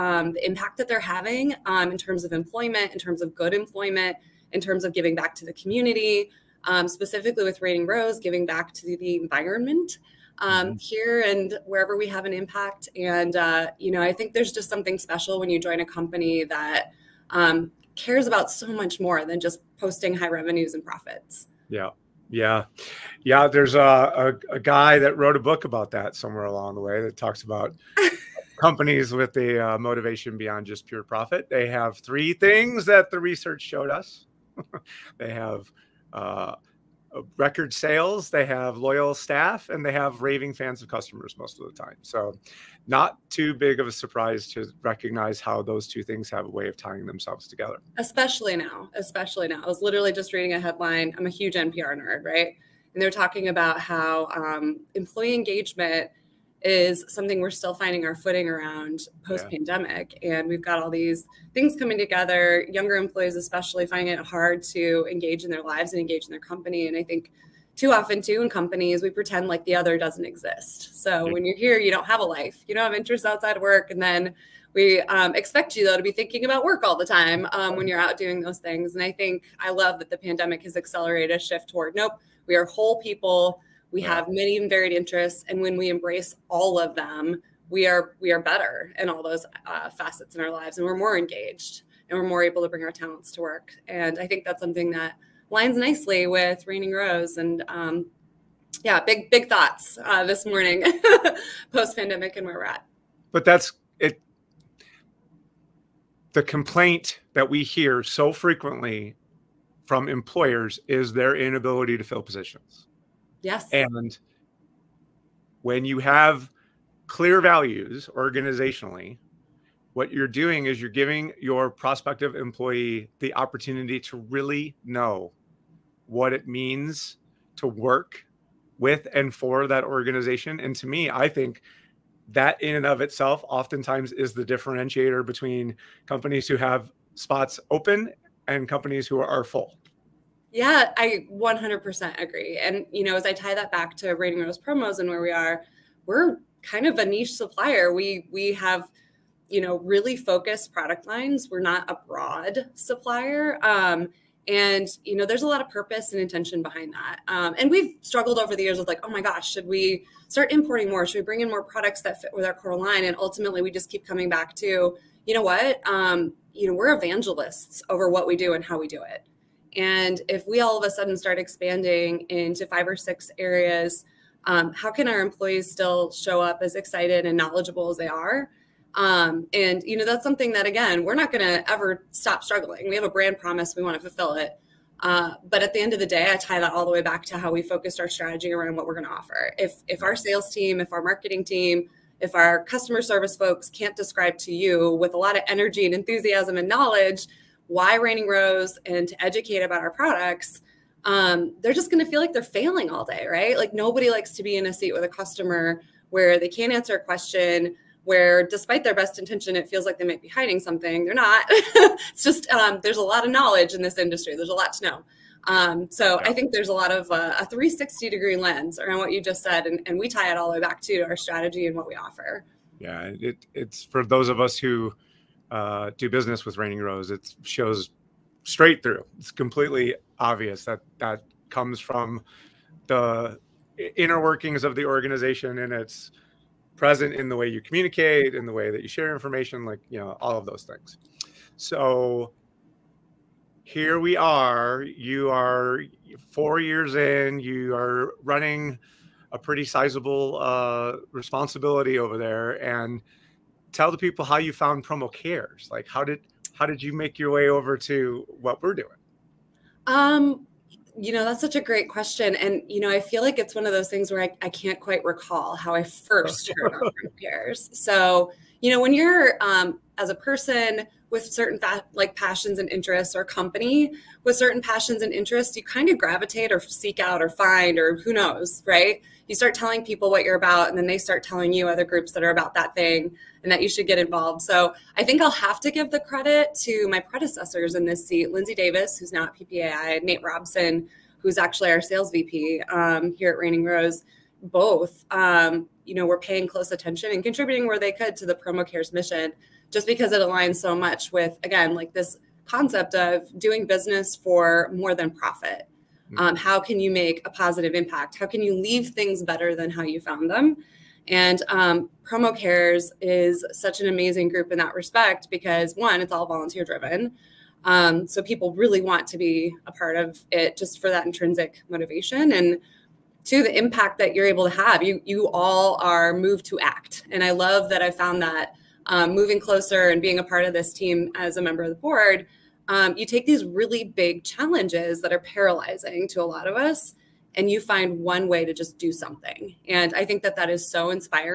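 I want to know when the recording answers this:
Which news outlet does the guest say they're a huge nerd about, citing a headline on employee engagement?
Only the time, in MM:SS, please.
00:51.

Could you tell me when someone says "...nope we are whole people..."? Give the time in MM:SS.
01:21.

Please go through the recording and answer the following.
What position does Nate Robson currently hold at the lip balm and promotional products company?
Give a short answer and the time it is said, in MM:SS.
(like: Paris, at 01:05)
Sales VP, at 04:51.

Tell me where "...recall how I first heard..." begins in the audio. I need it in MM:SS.
04:25.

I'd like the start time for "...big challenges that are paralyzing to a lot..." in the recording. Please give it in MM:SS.
05:33.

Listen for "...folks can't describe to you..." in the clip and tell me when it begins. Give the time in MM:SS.
03:13.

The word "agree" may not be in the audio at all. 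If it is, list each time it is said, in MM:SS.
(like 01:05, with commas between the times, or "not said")
02:22.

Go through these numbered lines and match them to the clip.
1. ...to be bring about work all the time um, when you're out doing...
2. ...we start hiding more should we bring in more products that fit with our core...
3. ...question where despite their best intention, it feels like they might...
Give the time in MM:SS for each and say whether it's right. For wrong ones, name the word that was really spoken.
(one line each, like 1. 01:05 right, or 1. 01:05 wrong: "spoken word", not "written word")
1. 01:15 wrong: "thinking", not "bring"
2. 02:39 wrong: "importing", not "hiding"
3. 03:27 right.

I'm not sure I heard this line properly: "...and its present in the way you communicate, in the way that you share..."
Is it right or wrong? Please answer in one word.
right.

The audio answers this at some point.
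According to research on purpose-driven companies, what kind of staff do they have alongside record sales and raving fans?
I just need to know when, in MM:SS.
00:38.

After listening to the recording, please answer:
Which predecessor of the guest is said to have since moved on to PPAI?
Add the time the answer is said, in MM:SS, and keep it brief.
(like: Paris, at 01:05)
Lindsay Davis, at 04:48.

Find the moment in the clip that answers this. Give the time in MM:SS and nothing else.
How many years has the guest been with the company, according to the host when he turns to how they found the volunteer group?
04:06.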